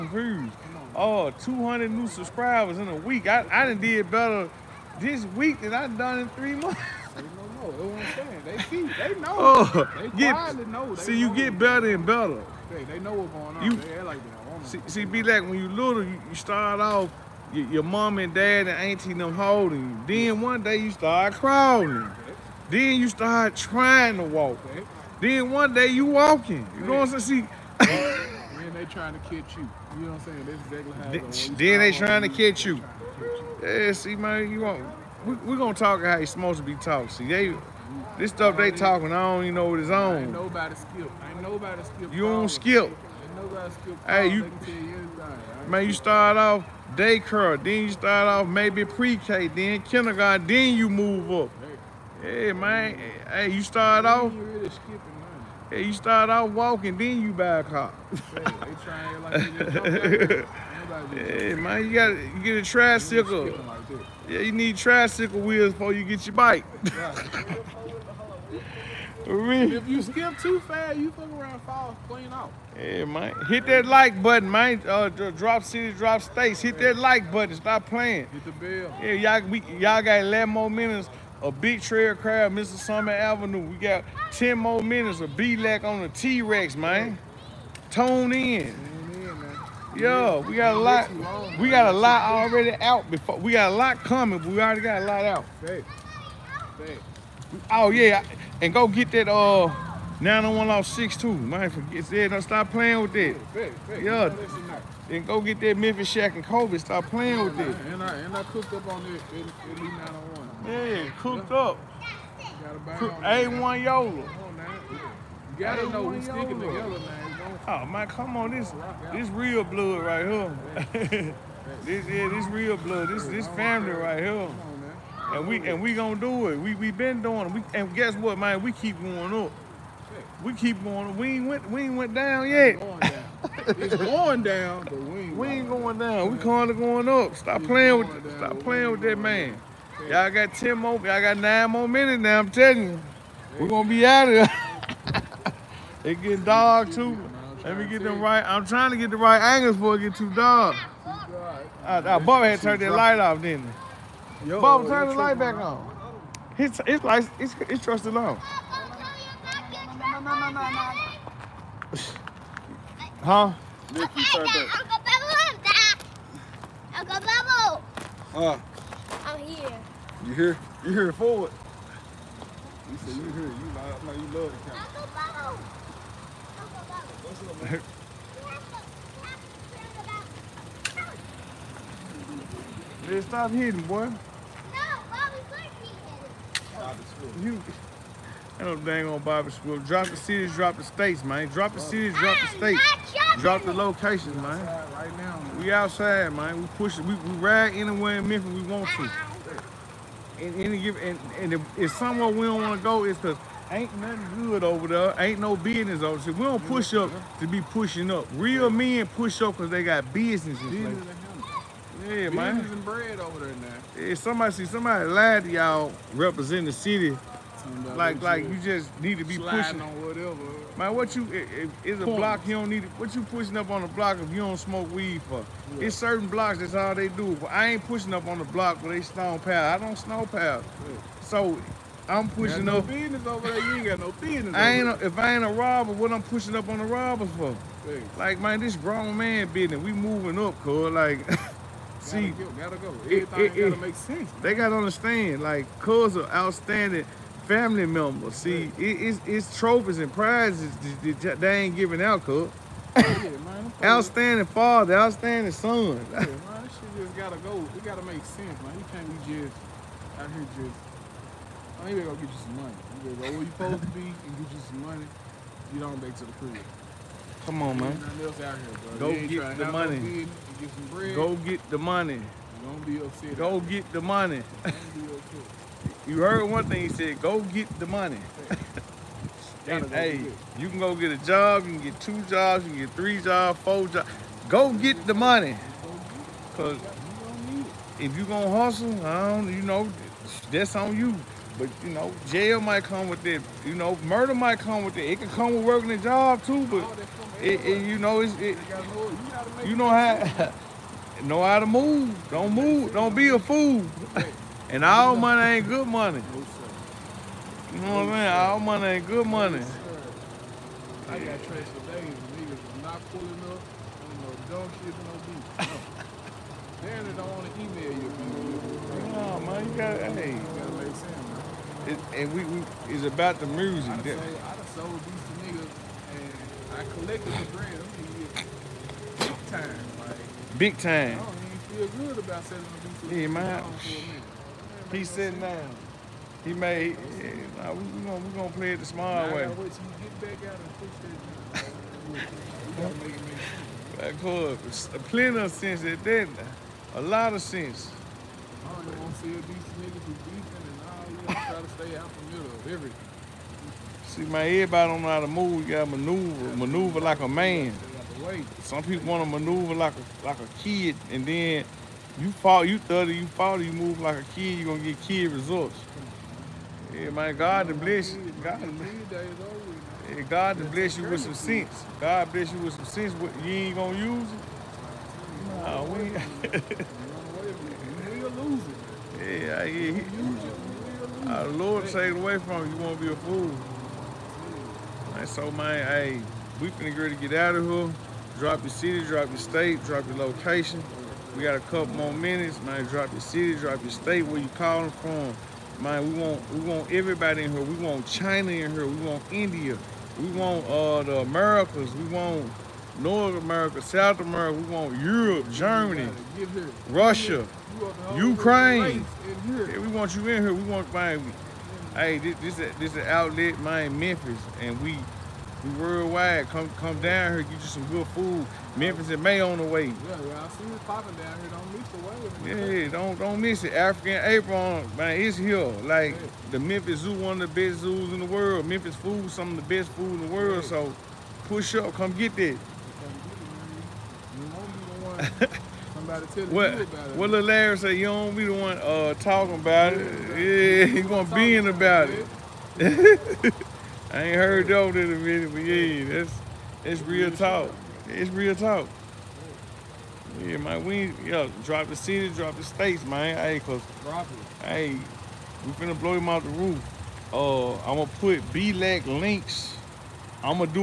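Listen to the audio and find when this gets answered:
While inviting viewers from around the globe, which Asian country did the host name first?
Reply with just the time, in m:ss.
6:38.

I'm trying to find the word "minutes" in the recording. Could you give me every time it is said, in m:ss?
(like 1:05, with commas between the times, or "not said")
1:20, 1:24, 2:21, 6:32, 7:25.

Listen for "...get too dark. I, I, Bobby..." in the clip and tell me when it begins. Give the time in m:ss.
2:30.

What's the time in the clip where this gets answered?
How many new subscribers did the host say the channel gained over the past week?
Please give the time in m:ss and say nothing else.
0:01.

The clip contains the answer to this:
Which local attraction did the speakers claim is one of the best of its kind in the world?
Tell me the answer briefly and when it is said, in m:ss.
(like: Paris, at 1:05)
Memphis Zoo, at 7:06.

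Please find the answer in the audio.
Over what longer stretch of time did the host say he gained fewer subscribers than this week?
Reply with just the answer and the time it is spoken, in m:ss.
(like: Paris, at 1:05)
three months, at 0:06.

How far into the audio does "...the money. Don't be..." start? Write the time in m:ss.
4:31.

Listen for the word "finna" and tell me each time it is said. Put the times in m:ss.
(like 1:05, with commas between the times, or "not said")
6:26, 7:35.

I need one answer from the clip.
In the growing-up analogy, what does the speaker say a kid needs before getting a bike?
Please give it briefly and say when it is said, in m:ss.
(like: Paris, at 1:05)
tricycle wheels, at 1:04.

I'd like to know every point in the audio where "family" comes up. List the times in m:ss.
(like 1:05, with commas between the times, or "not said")
2:03, 4:07.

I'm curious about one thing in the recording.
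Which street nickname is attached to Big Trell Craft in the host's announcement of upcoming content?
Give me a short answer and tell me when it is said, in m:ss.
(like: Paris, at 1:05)
Mr. Summer Avenue, at 1:22.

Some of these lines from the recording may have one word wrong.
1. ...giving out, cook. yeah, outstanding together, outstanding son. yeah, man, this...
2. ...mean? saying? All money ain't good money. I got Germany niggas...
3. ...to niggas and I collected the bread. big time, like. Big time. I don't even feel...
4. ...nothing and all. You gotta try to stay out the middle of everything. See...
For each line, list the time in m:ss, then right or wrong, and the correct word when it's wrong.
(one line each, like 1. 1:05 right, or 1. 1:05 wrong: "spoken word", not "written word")
1. 4:11 wrong: "father", not "together"
2. 5:08 wrong: "Transylvania", not "Germany"
3. 5:25 right
4. 5:50 wrong: "beefing", not "nothing".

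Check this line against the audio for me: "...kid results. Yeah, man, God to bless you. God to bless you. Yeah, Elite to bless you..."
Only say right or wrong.
wrong.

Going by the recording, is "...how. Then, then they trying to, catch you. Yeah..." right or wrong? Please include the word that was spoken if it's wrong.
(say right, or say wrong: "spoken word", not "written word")
right.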